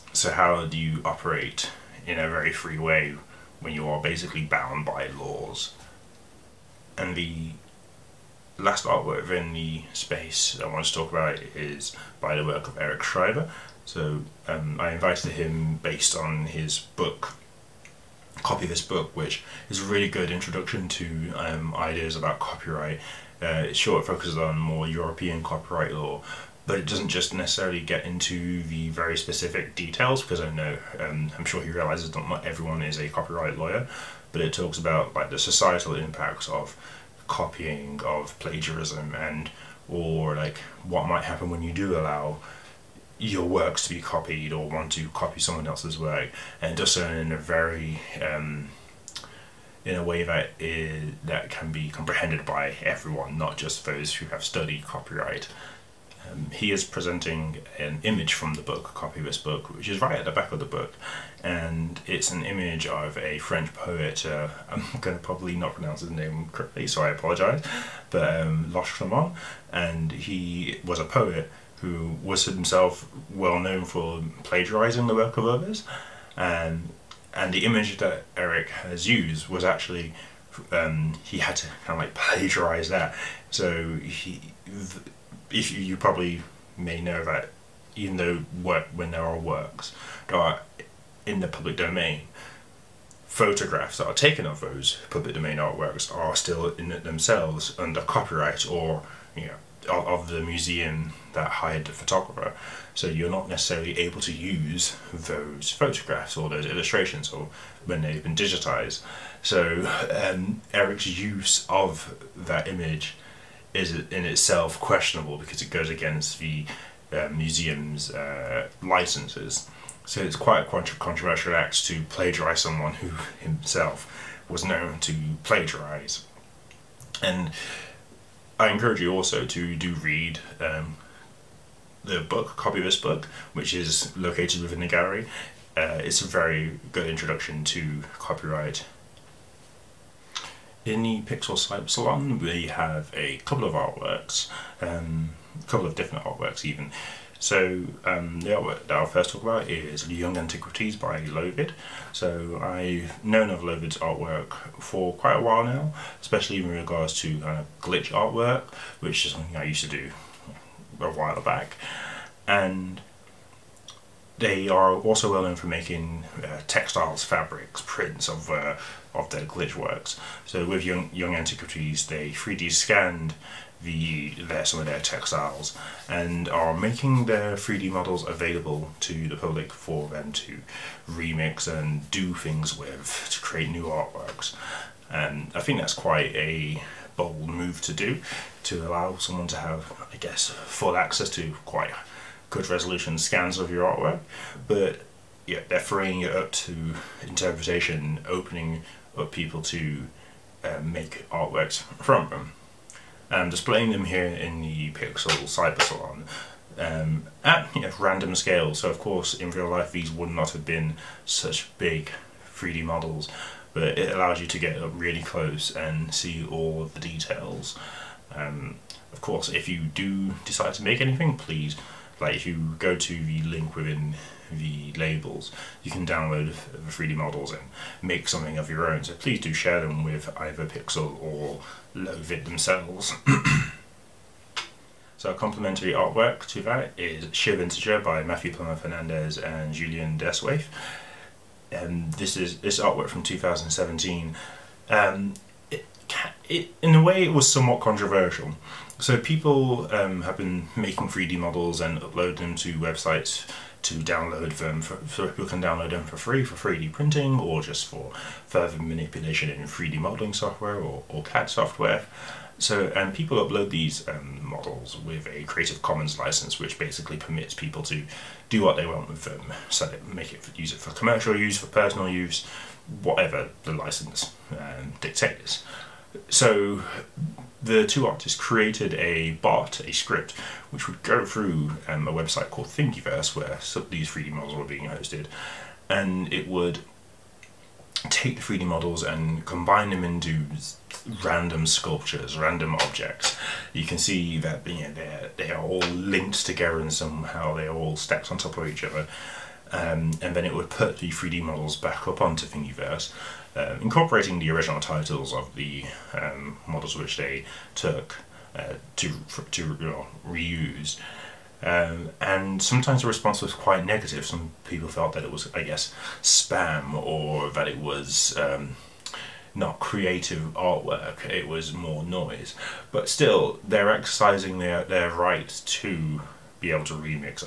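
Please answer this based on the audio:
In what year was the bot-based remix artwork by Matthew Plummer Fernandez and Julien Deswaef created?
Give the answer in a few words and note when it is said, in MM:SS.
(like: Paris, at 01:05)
2017, at 04:03.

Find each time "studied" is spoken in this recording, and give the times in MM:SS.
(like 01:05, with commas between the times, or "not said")
00:54.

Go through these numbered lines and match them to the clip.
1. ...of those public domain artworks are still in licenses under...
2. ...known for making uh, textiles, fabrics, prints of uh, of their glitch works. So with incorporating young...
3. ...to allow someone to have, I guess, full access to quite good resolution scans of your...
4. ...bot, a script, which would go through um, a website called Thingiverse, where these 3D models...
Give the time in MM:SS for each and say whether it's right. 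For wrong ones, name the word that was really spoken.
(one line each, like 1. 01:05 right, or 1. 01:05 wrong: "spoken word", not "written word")
1. 01:34 wrong: "themselves", not "licenses"
2. 02:45 wrong: "young", not "incorporating"
3. 03:08 right
4. 04:39 right.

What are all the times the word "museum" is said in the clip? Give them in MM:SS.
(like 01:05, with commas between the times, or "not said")
01:40, 01:57.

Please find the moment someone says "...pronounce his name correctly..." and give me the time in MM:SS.
01:05.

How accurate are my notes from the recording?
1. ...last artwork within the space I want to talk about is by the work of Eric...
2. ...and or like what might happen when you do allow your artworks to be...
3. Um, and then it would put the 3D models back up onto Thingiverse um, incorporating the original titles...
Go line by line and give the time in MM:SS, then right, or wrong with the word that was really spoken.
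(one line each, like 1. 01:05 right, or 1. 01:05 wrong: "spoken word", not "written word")
1. 00:08 right
2. 00:39 wrong: "works", not "artworks"
3. 04:59 right.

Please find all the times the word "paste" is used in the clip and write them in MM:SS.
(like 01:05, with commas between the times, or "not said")
not said.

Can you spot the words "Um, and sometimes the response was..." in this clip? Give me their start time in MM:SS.
05:11.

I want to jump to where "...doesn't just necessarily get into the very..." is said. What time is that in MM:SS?
00:26.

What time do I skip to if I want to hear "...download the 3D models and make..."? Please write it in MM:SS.
03:46.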